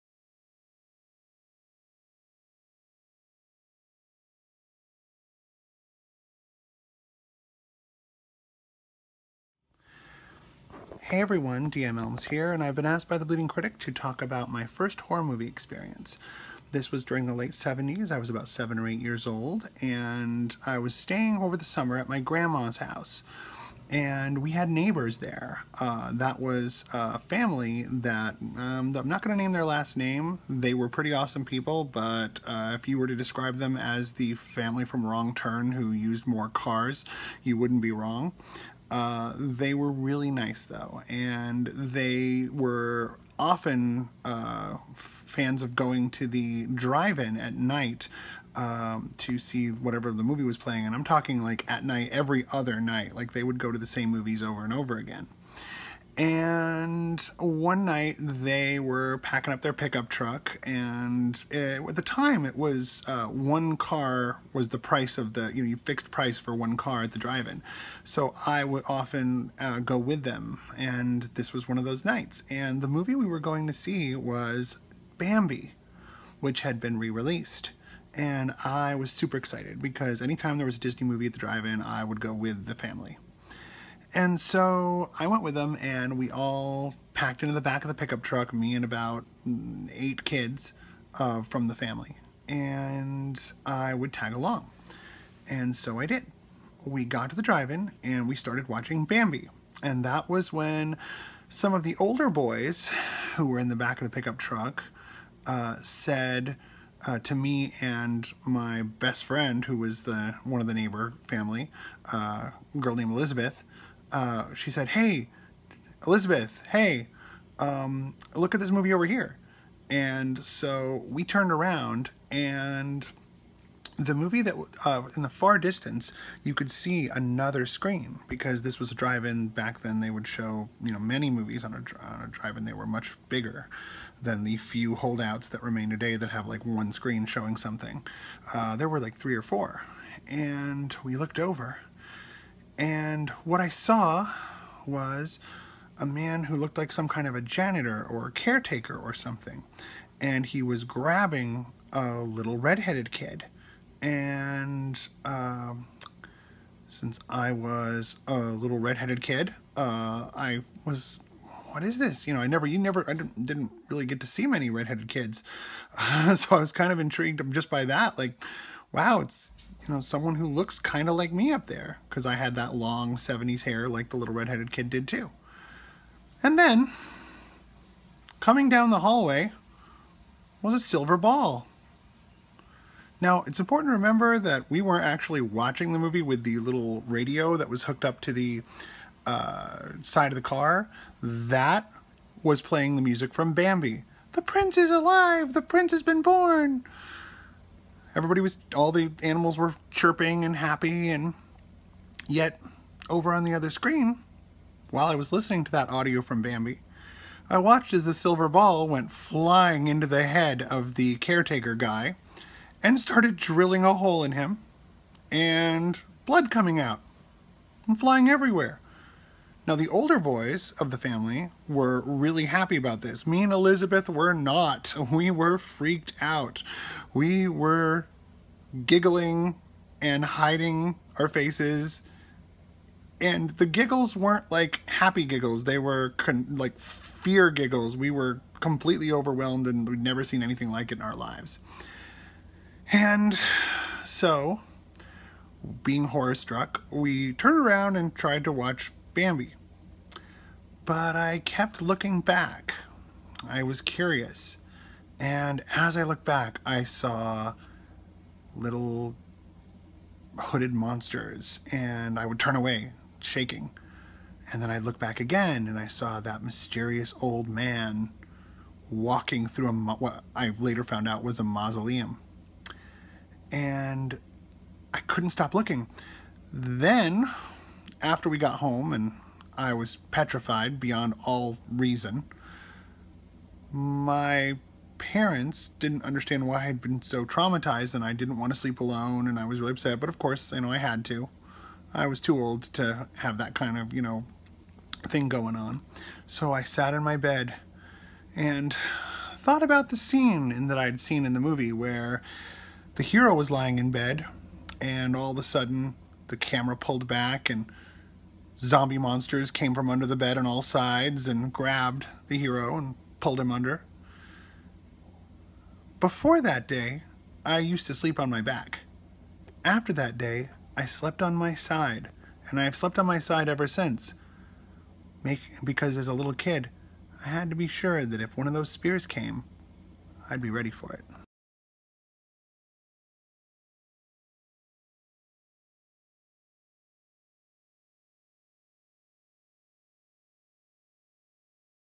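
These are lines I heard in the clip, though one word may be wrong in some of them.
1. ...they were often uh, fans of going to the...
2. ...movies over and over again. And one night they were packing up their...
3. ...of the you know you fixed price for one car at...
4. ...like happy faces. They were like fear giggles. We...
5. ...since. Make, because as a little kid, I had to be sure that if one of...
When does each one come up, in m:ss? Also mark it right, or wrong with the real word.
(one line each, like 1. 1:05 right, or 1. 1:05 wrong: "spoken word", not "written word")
1. 0:41 right
2. 0:54 right
3. 1:05 right
4. 3:54 wrong: "giggles", not "faces"
5. 5:23 right.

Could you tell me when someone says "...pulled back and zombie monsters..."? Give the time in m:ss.
5:06.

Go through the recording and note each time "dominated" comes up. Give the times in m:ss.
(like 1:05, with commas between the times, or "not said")
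not said.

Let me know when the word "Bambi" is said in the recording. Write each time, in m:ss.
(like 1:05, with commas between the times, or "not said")
1:15, 1:39, 3:13, 3:26, 4:09.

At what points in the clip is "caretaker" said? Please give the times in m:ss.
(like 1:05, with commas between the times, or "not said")
2:28, 3:31.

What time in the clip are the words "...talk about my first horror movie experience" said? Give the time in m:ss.
0:13.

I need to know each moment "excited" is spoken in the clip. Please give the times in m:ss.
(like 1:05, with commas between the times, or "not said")
1:19.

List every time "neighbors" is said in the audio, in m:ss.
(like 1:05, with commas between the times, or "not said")
0:24, 1:50.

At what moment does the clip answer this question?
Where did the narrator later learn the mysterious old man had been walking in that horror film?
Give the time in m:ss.
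4:31.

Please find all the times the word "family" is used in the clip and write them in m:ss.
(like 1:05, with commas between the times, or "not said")
0:27, 0:34, 1:22, 1:31, 1:51, 3:40.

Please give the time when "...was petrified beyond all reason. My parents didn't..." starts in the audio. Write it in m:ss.
4:39.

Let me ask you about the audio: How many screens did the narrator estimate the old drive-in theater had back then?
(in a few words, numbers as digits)
3 or 4.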